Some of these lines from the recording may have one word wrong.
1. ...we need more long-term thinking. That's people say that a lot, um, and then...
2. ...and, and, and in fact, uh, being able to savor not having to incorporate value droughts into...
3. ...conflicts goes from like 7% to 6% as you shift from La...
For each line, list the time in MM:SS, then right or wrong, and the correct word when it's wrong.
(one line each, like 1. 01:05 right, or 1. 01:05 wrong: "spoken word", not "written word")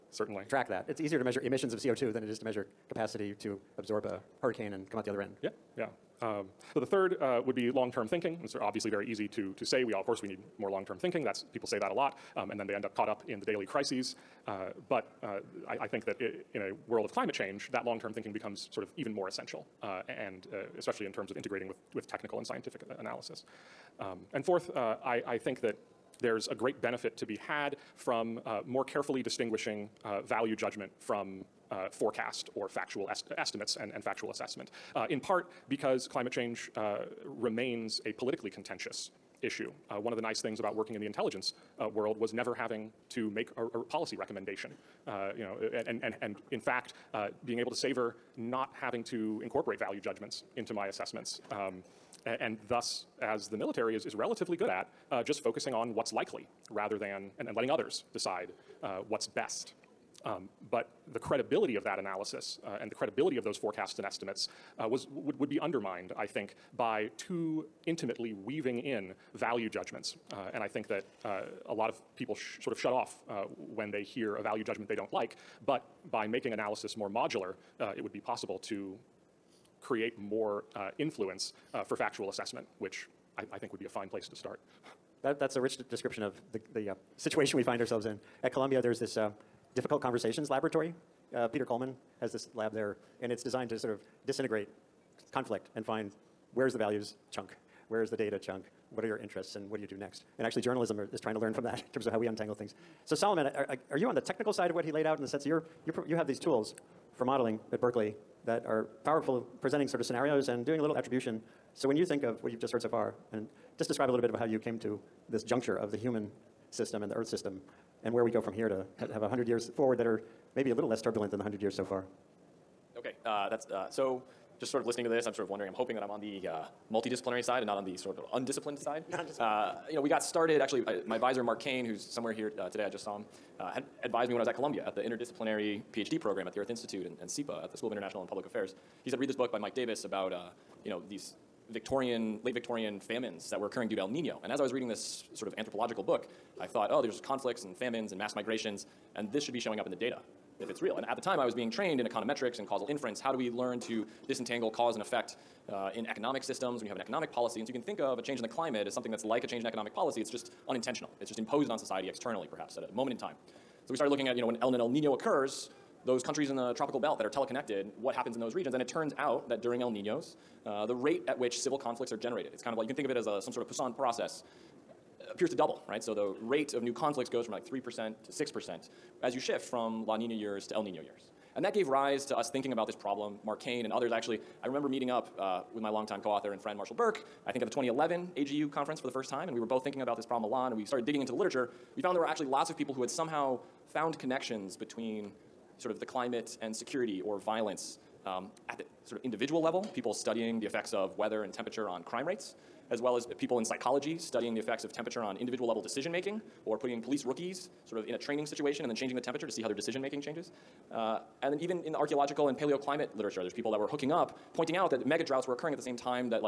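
1. 00:10 right
2. 00:45 wrong: "judgments", not "droughts"
3. 02:56 wrong: "3", not "7".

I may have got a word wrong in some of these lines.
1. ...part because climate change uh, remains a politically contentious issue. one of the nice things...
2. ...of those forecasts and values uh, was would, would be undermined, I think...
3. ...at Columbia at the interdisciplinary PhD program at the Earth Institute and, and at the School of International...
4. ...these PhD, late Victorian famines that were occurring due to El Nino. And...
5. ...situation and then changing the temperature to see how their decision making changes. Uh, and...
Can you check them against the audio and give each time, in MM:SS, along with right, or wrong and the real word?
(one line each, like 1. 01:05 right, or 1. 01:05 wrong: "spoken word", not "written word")
1. 00:35 right
2. 01:03 wrong: "estimates", not "values"
3. 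02:14 right
4. 02:21 wrong: "Victorian", not "PhD"
5. 03:28 right.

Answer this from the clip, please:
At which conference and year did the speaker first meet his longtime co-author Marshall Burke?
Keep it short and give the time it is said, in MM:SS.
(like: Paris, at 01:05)
2011 AGU, at 03:07.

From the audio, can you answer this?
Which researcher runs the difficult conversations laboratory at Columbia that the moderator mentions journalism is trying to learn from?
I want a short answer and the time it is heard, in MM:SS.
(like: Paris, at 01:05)
Peter Coleman, at 01:31.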